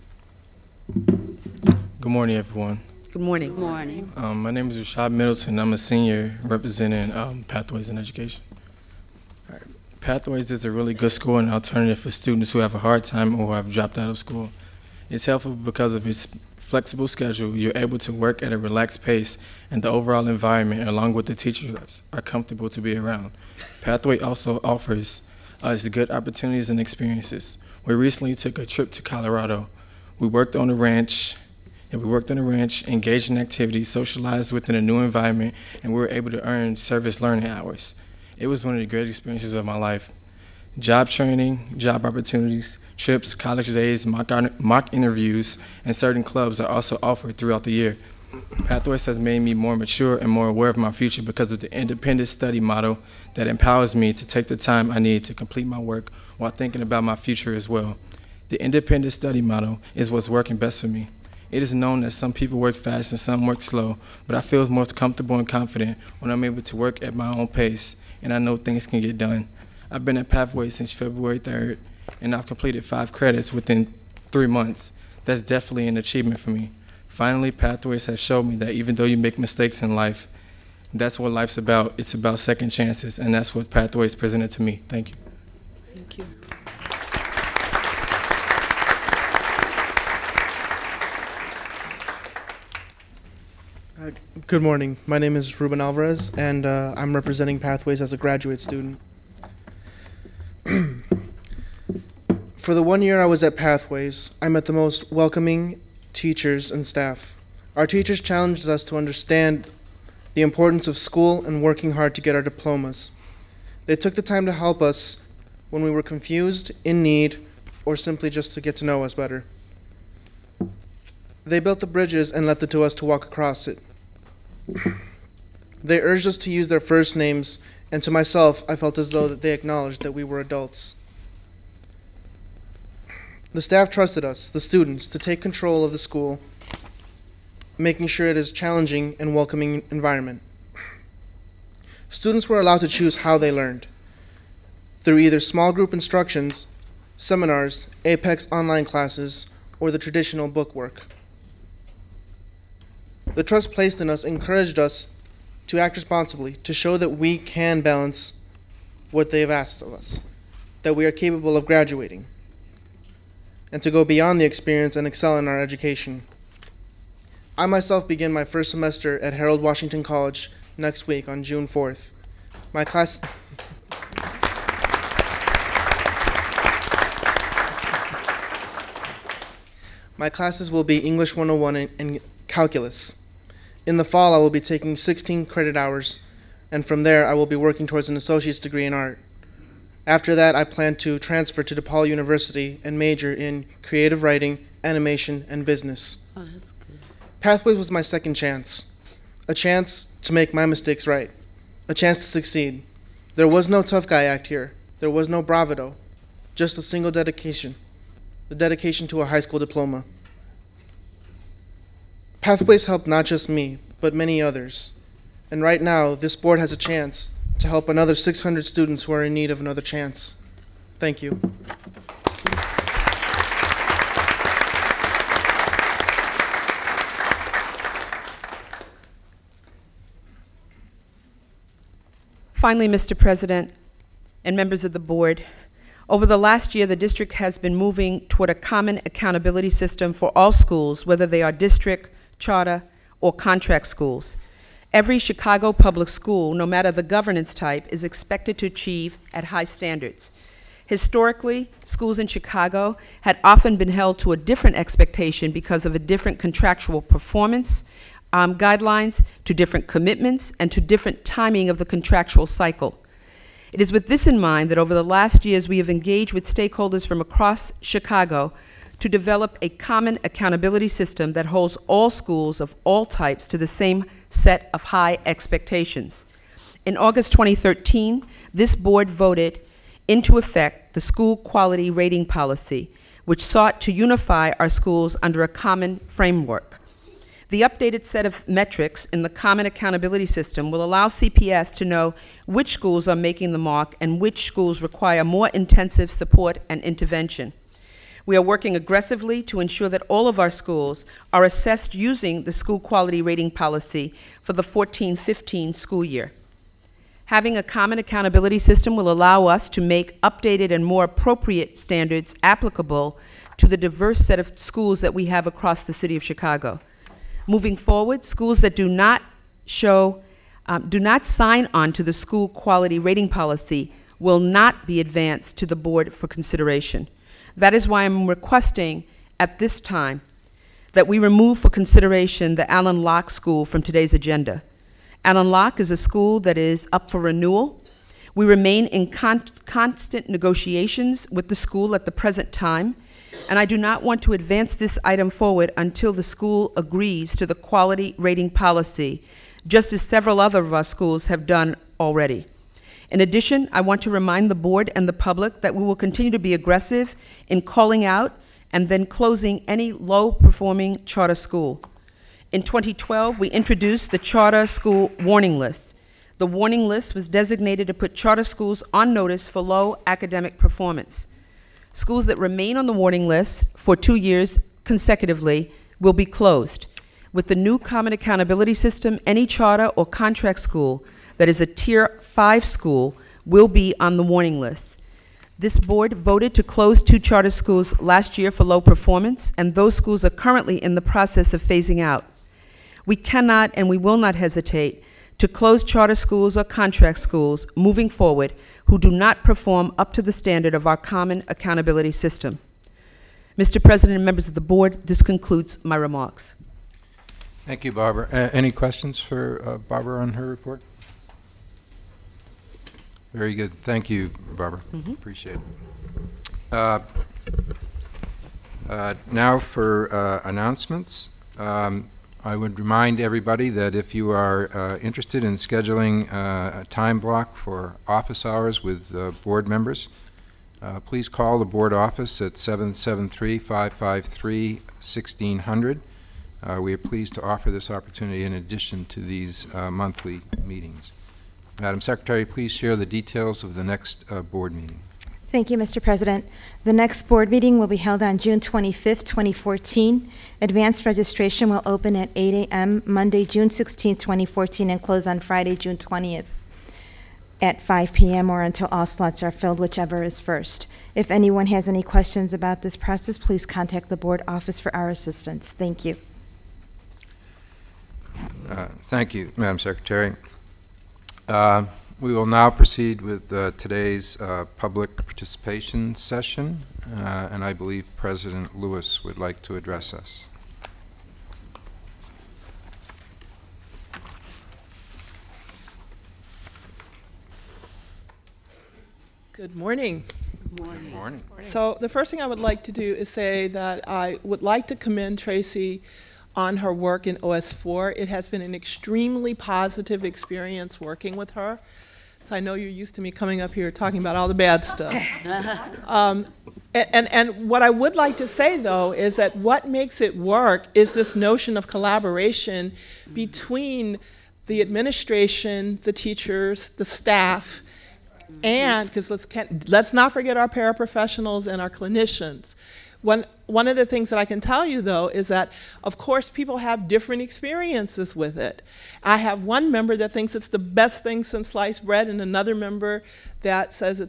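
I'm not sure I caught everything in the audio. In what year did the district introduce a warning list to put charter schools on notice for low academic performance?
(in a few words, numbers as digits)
2012.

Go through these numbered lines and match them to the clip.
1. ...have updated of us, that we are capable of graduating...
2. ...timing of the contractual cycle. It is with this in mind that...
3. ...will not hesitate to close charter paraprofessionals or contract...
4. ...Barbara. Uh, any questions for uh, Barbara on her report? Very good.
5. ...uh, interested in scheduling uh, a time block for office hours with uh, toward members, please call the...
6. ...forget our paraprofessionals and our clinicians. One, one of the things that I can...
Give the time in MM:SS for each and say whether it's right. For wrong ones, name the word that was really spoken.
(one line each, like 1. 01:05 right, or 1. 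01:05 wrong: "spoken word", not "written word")
1. 02:39 wrong: "asked", not "updated"
2. 04:21 right
3. 06:33 wrong: "schools", not "paraprofessionals"
4. 06:47 right
5. 07:04 wrong: "board", not "toward"
6. 08:40 right.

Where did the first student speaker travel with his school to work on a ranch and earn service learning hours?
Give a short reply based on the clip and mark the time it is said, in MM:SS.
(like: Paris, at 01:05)
Colorado, at 00:29.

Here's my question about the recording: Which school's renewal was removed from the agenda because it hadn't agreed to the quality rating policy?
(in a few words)
Alain Locke School.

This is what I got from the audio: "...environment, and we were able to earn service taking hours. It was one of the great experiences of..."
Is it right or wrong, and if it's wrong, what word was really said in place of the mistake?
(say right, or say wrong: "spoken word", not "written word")
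wrong: "learning", not "taking".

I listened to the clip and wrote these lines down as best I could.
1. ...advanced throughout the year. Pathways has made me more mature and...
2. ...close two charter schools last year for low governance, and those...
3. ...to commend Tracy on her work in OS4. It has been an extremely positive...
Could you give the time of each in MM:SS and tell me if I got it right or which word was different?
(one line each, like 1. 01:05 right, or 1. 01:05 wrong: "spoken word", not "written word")
1. 00:47 wrong: "offered", not "advanced"
2. 06:26 wrong: "performance", not "governance"
3. 08:14 right.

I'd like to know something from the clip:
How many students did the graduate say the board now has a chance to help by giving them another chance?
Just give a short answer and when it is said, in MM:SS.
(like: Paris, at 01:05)
600, at 03:38.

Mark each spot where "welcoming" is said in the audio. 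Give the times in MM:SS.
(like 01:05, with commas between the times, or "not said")
01:45, 02:19.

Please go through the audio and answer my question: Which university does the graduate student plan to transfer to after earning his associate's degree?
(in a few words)
DePaul University.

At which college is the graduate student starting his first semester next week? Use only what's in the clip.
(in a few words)
Harold Washington College.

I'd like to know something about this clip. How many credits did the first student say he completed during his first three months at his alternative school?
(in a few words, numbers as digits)
5.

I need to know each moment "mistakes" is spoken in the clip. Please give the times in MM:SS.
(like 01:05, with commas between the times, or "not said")
01:19, 03:20.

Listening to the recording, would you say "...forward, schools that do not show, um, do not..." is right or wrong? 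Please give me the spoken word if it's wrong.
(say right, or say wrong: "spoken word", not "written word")
right.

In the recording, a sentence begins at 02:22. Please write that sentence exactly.
Students were allowed to choose how they learned through either small group instructions, seminars, Apex online classes, or the traditional bookwork.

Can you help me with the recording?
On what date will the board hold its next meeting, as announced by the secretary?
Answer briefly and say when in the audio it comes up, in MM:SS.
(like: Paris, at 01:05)
June 25, 2014, at 07:28.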